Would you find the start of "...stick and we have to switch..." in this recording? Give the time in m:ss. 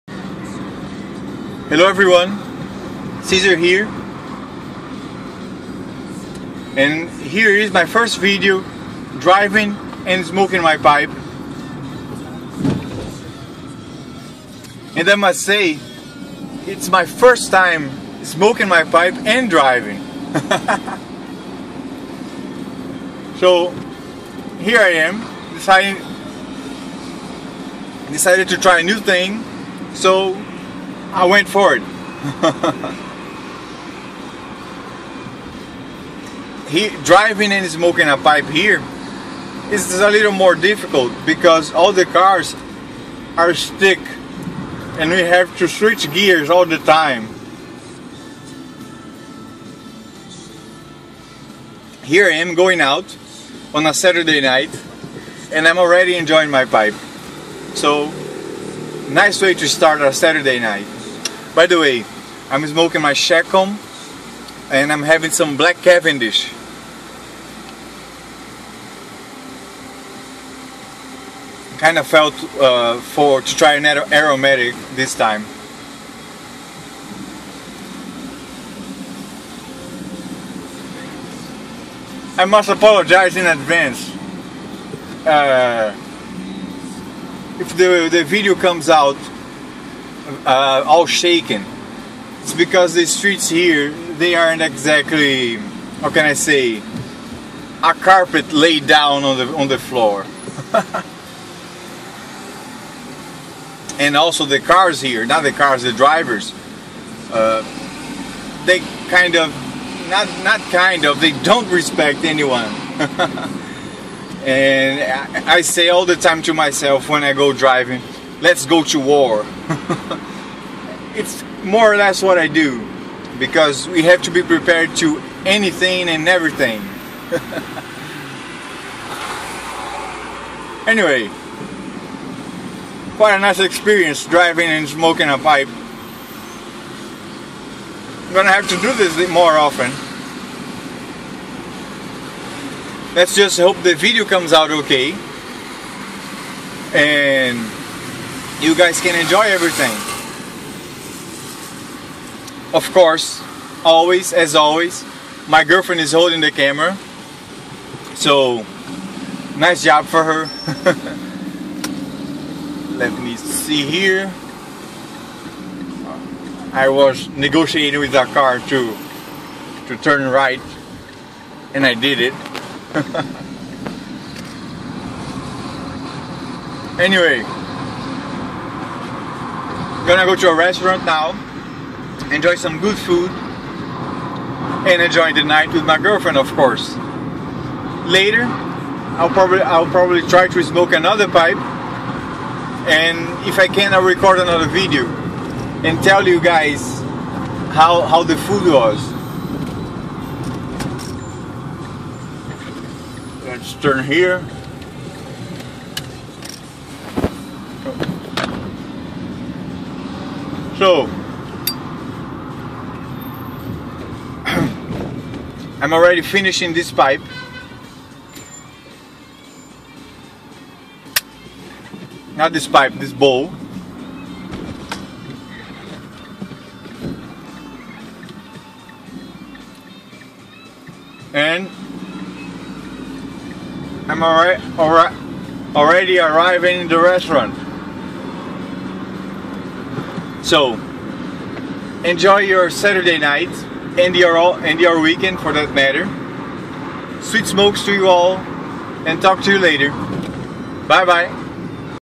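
0:43.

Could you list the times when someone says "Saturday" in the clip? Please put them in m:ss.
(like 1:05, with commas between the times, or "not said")
0:53, 1:00, 4:02.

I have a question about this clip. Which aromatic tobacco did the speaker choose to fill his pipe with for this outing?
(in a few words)
Black Cavendish.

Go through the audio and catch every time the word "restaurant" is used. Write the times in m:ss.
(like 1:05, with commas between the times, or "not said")
3:00, 3:56.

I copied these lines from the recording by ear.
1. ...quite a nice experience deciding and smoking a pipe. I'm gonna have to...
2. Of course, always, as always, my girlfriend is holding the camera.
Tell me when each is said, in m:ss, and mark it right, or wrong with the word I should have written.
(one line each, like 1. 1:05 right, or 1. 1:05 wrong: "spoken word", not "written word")
1. 2:13 wrong: "driving", not "deciding"
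2. 2:32 right.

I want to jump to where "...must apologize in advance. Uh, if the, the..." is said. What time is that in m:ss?
1:22.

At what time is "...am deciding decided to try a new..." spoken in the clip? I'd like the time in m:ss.
0:25.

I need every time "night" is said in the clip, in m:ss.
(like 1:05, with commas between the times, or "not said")
0:54, 1:00, 3:05, 4:03.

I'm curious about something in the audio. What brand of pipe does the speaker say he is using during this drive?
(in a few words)
Chacom.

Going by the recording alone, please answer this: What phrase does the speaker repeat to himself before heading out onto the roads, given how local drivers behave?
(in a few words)
Let's go to war.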